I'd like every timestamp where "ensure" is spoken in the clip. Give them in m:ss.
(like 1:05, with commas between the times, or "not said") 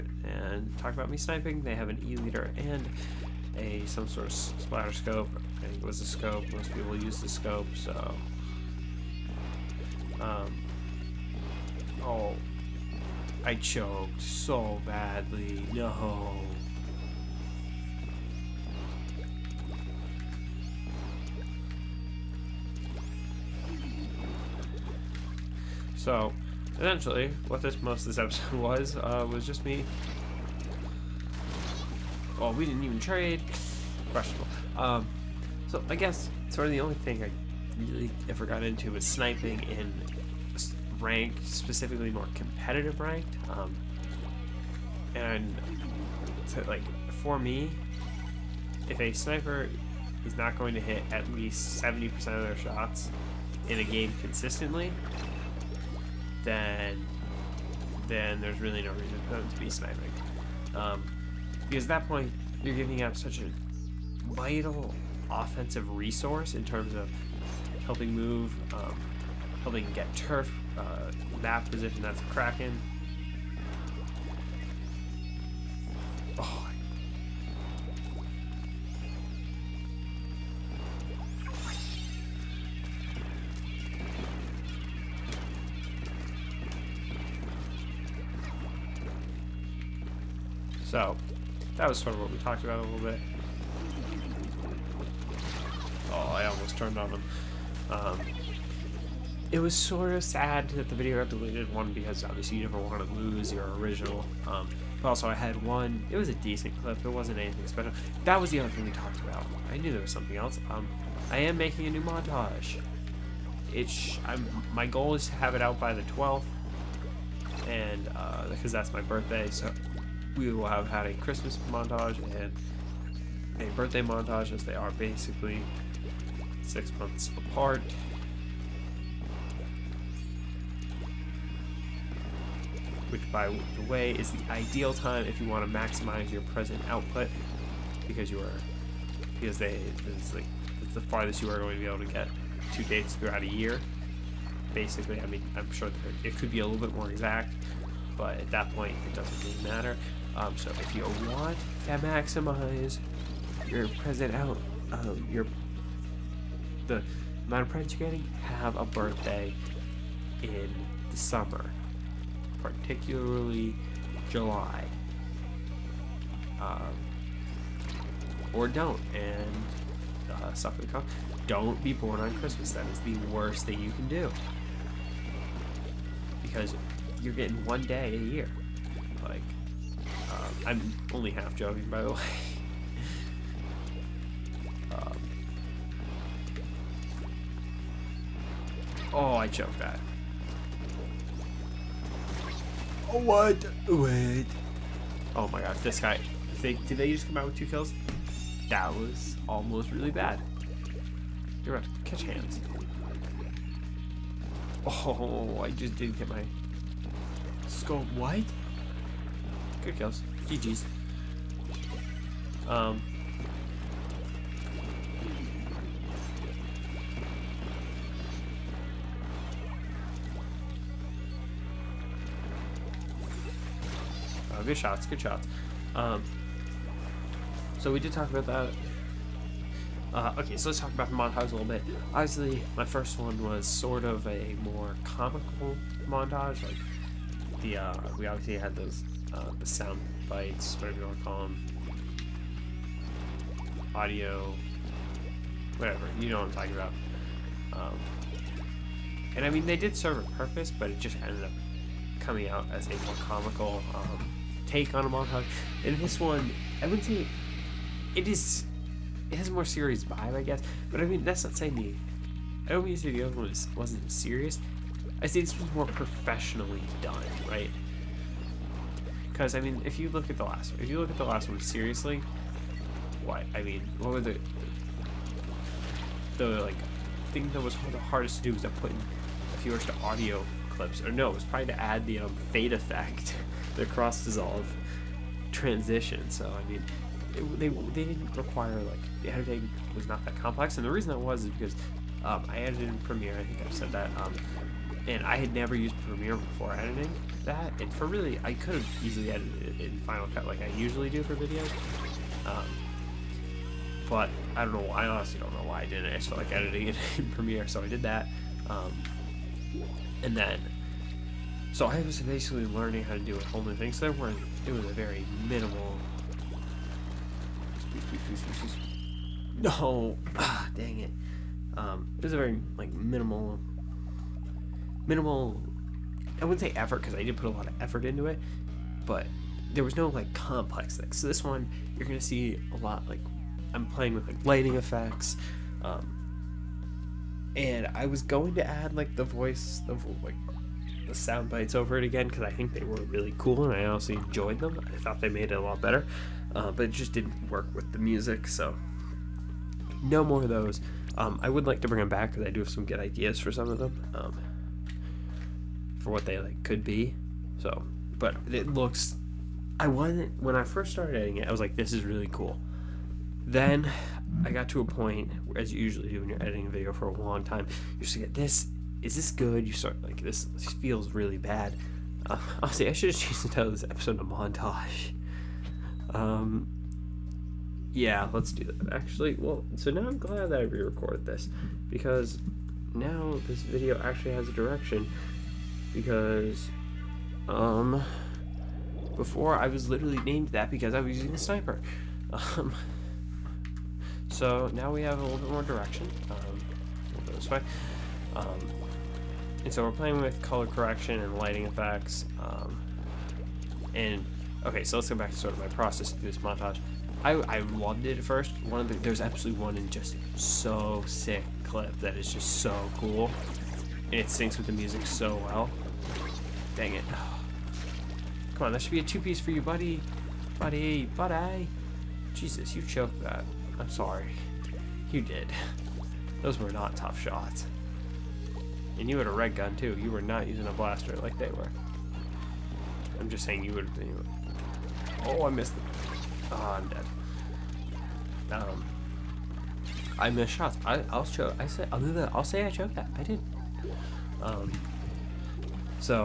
not said.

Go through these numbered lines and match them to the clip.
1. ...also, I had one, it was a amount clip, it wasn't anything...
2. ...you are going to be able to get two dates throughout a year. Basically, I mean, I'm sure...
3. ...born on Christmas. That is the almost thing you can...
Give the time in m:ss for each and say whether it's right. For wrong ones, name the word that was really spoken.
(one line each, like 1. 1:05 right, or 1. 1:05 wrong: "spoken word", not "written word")
1. 1:45 wrong: "decent", not "amount"
2. 2:21 right
3. 2:51 wrong: "worst", not "almost".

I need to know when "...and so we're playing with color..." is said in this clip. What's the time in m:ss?
6:39.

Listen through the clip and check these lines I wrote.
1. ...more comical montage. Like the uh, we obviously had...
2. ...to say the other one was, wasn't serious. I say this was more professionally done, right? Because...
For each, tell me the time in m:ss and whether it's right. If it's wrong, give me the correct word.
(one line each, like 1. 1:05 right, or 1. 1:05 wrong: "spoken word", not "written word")
1. 3:54 right
2. 4:22 right.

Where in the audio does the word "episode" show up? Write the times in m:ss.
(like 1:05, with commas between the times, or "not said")
0:28, 6:13.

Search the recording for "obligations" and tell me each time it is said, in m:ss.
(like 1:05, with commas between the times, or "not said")
not said.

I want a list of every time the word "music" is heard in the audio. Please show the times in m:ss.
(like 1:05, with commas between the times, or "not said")
5:47, 6:54.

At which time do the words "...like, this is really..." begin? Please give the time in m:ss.
6:01.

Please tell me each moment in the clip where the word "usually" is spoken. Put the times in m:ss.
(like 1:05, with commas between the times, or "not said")
5:00, 6:05.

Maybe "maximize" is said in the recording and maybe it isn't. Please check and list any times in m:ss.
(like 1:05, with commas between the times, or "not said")
2:15, 2:31.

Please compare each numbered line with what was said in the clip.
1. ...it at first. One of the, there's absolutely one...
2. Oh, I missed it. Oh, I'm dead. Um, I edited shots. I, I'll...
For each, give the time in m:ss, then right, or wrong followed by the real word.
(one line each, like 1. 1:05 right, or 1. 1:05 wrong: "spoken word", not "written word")
1. 6:48 right
2. 7:15 wrong: "missed", not "edited".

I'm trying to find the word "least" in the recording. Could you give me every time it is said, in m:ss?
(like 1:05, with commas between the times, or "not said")
0:51.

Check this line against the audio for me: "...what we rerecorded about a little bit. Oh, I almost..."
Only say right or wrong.
wrong.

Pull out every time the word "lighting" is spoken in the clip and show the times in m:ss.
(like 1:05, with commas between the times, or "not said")
5:34, 6:41.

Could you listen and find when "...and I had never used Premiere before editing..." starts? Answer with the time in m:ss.
4:55.